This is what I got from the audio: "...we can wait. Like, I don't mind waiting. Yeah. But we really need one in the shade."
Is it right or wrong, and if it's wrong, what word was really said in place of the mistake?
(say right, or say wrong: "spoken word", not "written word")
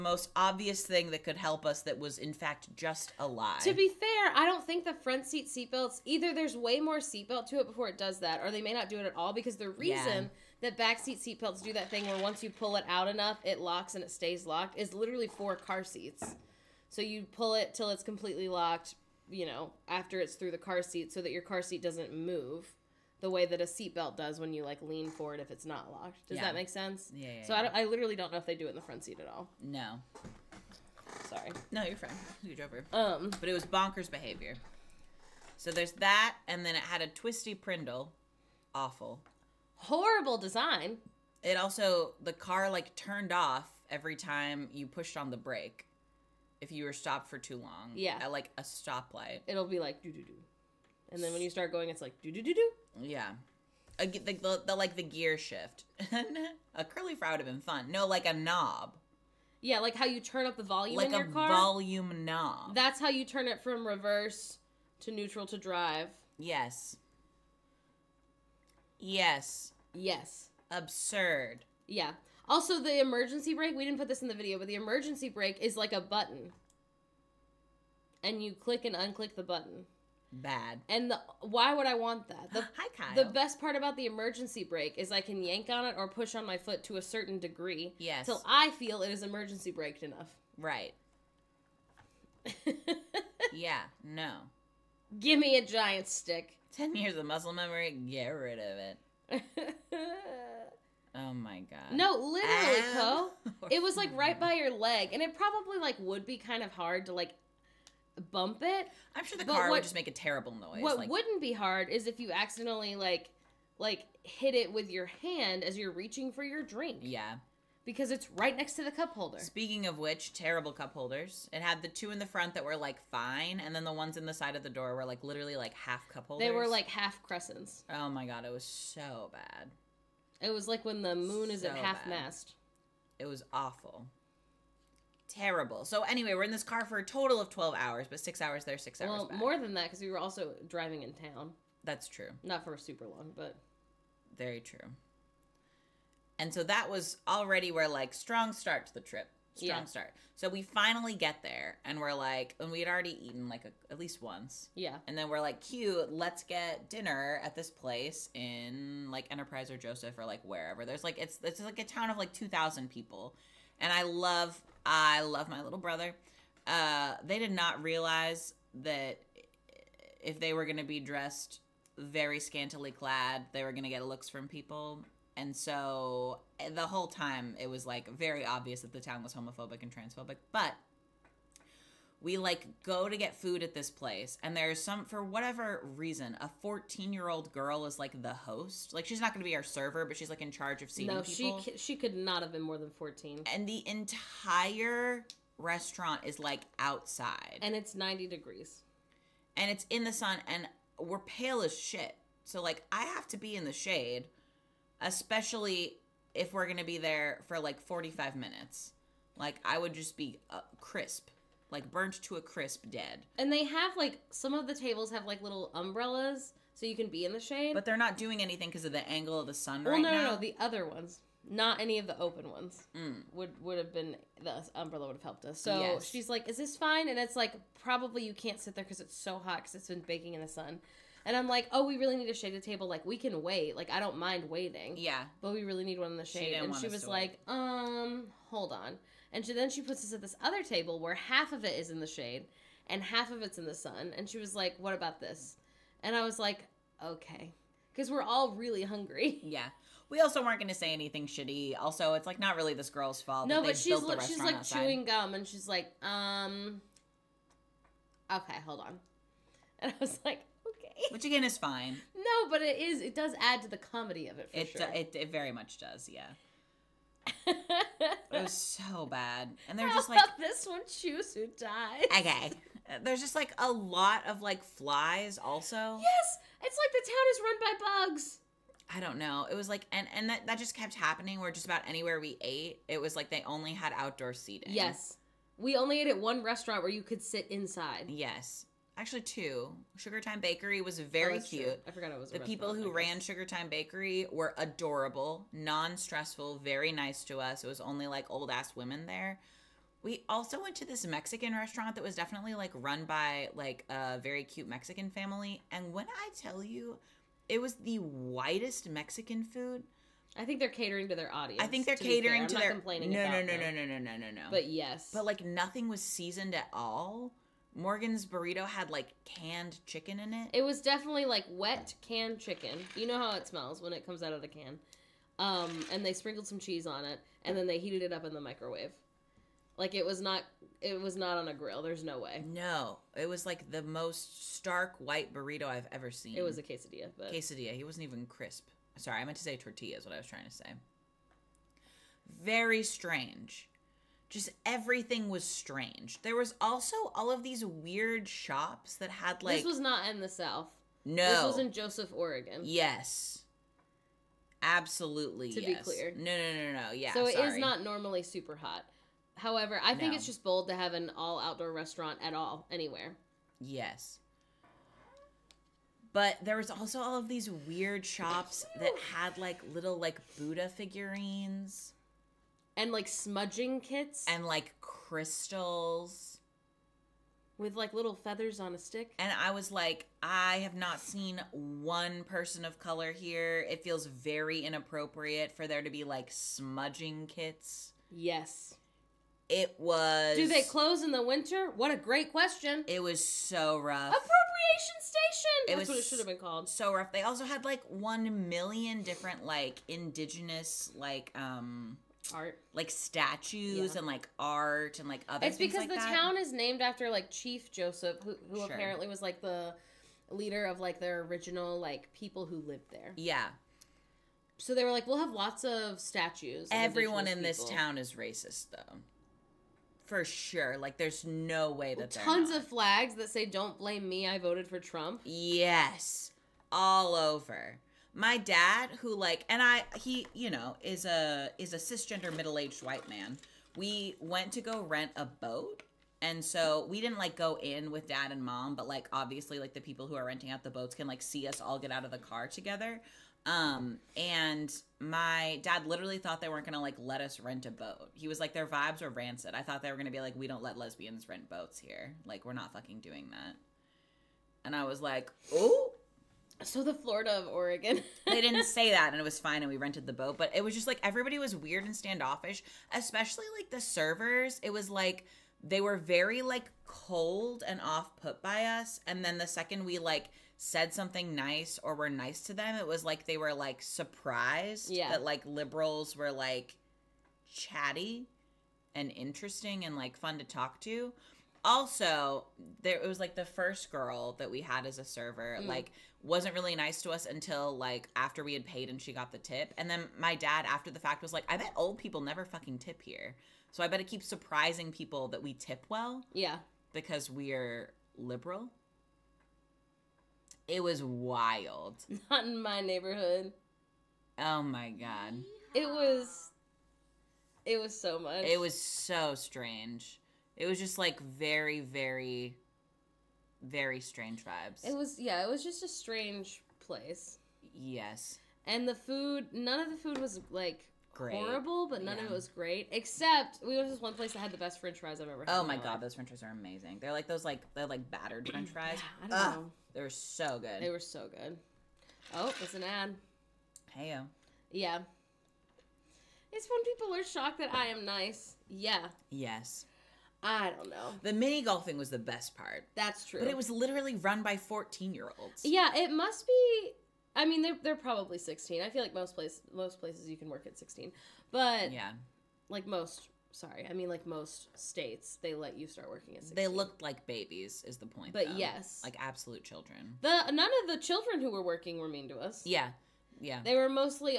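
right.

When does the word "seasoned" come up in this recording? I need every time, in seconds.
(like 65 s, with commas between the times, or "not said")
315 s.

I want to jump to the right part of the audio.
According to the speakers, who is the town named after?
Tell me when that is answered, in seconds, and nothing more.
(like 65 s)
407 s.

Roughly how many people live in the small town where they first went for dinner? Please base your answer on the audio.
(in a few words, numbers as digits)
2,000.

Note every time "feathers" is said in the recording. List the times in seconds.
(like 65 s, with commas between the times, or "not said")
378 s.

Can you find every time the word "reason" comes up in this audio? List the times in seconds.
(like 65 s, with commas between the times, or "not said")
9 s, 185 s.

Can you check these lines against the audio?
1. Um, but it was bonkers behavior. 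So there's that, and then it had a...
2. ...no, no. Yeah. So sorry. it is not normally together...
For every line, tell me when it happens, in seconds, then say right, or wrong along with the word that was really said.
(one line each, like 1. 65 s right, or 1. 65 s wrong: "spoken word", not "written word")
1. 32 s right
2. 356 s wrong: "super", not "together".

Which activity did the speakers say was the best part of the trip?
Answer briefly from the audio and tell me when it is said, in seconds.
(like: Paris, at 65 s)
Mini golfing, at 541 s.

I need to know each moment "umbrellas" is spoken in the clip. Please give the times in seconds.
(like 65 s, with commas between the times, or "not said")
215 s, 224 s.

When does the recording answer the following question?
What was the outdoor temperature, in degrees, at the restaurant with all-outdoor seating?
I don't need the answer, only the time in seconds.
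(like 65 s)
197 s.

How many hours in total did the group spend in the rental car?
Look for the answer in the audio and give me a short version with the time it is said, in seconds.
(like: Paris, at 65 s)
12, at 137 s.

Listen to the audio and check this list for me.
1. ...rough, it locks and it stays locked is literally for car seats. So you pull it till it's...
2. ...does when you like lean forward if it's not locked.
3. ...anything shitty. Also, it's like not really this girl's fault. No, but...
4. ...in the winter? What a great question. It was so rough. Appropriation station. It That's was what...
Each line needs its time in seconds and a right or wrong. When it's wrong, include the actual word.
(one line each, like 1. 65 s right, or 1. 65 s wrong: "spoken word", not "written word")
1. 13 s wrong: "enough", not "rough"
2. 24 s right
3. 250 s right
4. 391 s right.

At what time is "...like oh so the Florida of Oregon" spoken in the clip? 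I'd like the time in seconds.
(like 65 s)
454 s.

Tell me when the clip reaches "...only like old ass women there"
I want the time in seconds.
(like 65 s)
297 s.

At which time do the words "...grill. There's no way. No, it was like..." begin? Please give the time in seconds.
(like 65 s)
331 s.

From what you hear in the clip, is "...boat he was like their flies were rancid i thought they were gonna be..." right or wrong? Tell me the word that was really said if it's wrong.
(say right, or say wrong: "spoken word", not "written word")
wrong: "vibes", not "flies".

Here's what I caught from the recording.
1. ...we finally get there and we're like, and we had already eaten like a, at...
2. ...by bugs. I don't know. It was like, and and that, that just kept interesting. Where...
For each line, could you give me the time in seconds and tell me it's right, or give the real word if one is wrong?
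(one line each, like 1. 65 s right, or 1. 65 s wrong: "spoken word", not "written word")
1. 150 s right
2. 277 s wrong: "happening", not "interesting".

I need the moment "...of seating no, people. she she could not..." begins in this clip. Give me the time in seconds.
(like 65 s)
190 s.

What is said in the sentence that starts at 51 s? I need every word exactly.
And then when you start going it's like do do do do.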